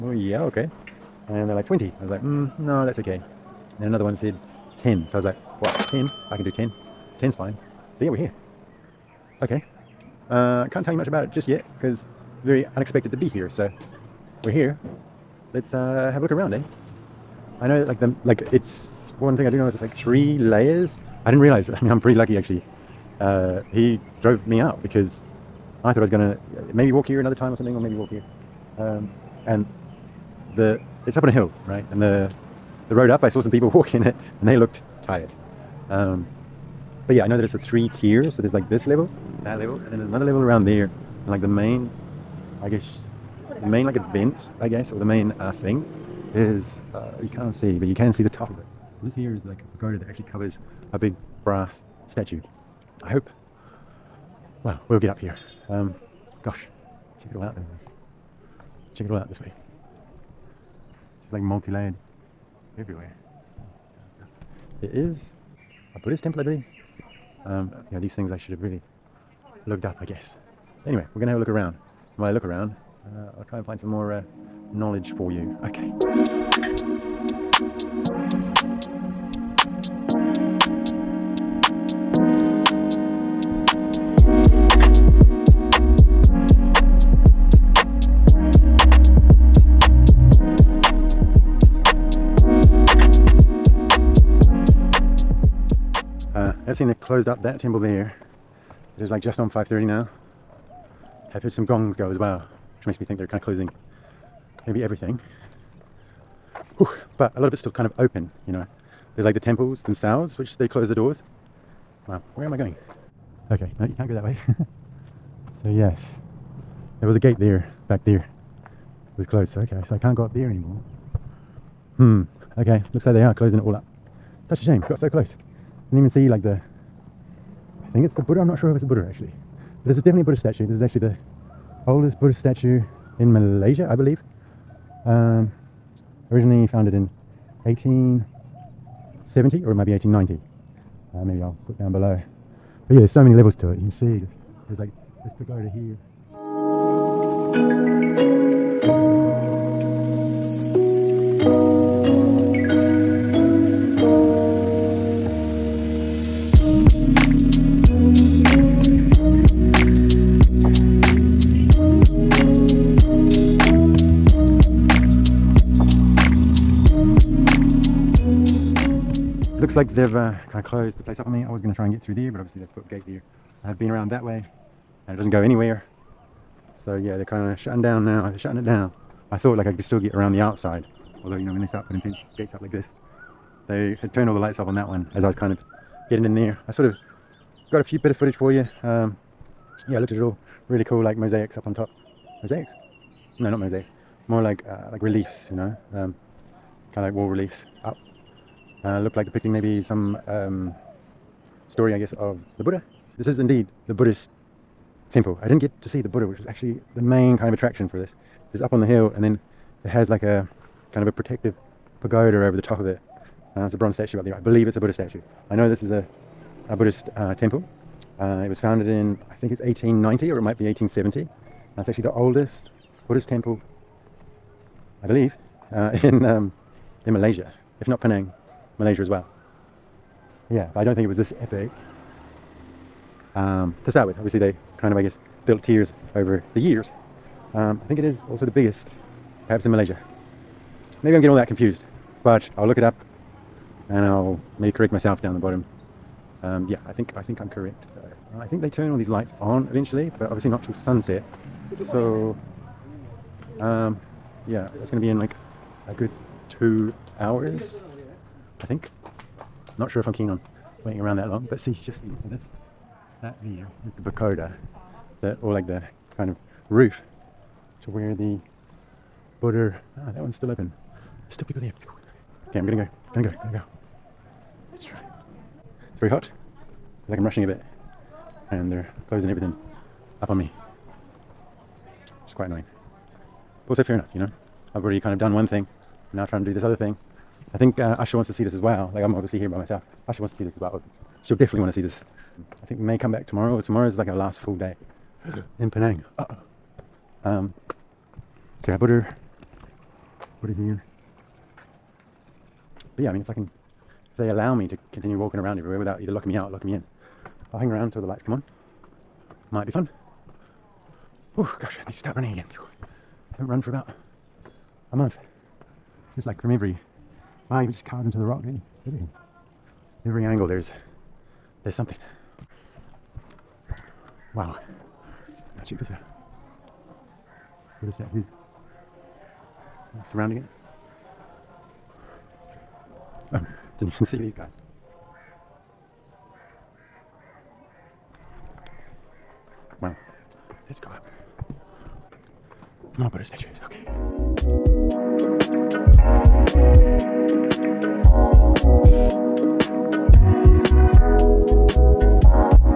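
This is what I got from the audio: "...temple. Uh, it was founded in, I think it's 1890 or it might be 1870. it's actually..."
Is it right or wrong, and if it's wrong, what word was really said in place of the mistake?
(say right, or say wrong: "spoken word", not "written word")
right.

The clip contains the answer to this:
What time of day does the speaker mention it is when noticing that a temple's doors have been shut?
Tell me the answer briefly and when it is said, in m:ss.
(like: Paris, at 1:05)
5:30, at 1:39.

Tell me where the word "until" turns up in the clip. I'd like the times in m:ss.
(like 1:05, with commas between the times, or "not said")
5:07.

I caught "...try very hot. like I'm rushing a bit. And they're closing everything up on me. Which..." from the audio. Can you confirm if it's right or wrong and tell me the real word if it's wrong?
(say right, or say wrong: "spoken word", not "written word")
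right.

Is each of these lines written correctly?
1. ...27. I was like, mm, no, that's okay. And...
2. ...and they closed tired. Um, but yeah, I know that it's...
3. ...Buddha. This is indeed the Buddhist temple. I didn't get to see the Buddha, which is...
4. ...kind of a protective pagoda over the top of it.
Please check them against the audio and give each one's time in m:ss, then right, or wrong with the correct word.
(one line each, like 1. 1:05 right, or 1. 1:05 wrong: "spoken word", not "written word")
1. 0:01 wrong: "20", not "27"
2. 0:34 wrong: "looked", not "closed"
3. 3:22 right
4. 3:30 right.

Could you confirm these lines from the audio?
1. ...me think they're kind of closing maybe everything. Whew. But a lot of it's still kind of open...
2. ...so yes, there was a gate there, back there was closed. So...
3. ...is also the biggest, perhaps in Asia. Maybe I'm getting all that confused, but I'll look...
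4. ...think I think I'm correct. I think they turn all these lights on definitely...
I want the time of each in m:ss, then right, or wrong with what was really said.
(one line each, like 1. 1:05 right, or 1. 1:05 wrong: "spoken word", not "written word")
1. 1:43 right
2. 1:55 right
3. 3:58 wrong: "Malaysia", not "Asia"
4. 4:06 wrong: "eventually", not "definitely".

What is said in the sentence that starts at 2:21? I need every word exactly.
Uh, maybe I'll put down below.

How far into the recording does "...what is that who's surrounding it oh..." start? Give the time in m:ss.
5:27.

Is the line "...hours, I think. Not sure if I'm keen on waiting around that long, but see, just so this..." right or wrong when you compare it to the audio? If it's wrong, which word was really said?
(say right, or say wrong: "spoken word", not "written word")
right.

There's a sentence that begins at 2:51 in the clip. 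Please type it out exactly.
I was going to try and get through there, but obviously they've put a gate there.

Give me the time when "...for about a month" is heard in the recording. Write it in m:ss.
5:13.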